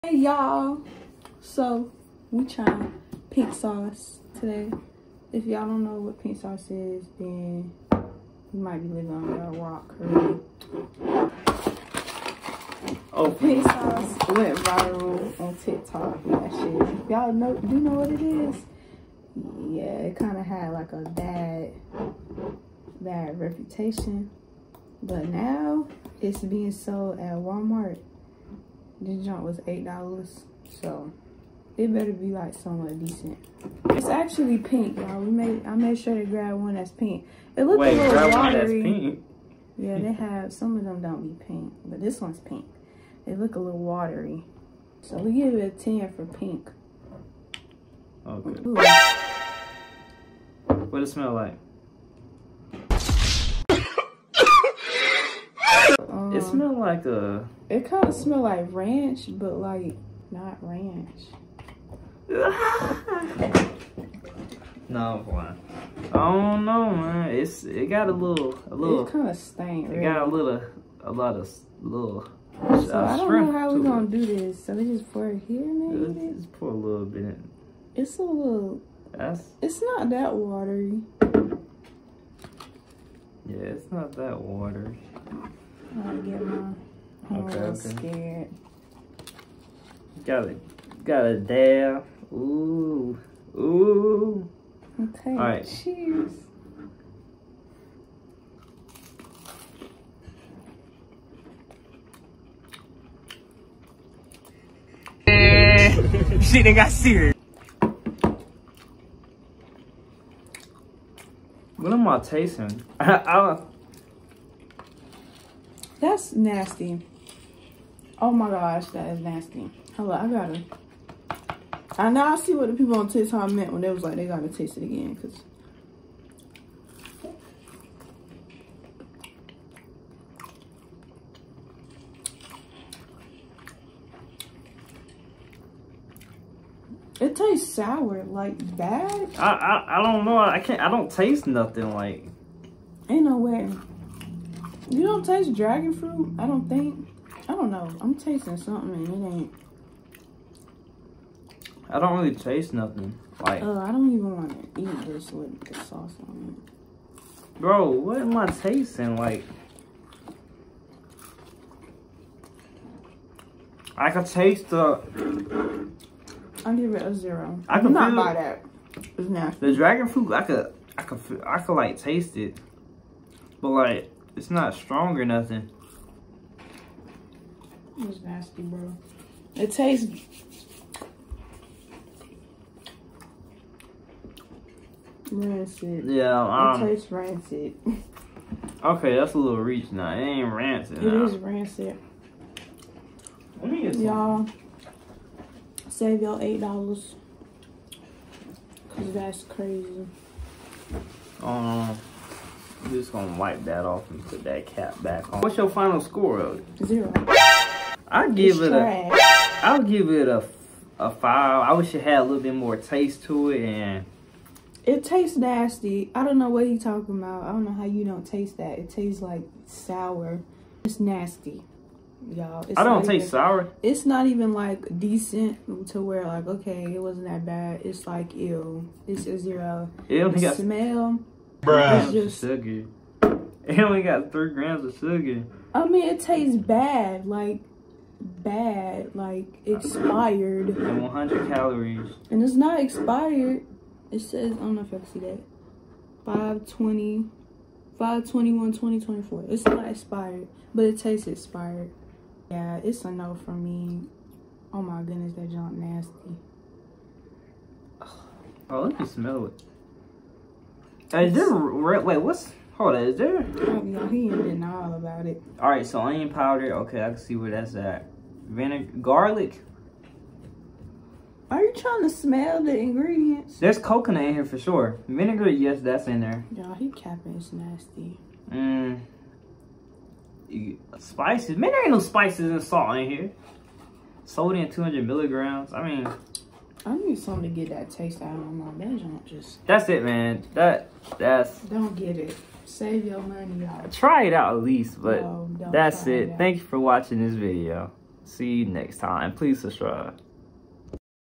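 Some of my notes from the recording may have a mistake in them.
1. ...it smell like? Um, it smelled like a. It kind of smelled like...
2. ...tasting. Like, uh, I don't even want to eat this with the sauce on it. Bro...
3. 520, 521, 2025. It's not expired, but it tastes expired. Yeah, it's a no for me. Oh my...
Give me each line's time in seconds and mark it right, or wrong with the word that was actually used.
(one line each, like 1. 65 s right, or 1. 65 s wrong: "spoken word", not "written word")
1. 51 s right
2. 152 s wrong: "nothing", not "tasting"
3. 246 s wrong: "2024", not "2025".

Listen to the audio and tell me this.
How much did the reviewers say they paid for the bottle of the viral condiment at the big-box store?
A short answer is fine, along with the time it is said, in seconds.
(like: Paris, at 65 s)
$8, at 29 s.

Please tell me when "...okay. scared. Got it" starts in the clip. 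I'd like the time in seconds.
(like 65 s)
87 s.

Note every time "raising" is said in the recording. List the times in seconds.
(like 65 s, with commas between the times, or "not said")
not said.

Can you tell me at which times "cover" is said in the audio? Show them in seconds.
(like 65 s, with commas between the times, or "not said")
not said.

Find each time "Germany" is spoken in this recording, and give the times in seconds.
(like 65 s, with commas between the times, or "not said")
not said.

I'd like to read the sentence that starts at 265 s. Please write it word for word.
All right, so onion powder, okay, I can see where that's at.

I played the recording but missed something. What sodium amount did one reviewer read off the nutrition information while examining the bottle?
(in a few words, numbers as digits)
200 milligrams.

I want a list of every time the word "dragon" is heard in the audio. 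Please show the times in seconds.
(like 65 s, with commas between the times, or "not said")
145 s, 169 s.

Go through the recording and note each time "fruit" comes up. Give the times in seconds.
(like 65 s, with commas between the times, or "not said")
145 s, 170 s.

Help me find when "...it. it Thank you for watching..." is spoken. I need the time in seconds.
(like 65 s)
296 s.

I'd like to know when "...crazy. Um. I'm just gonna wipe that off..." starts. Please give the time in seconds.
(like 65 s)
199 s.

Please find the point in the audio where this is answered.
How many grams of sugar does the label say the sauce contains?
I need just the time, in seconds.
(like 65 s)
234 s.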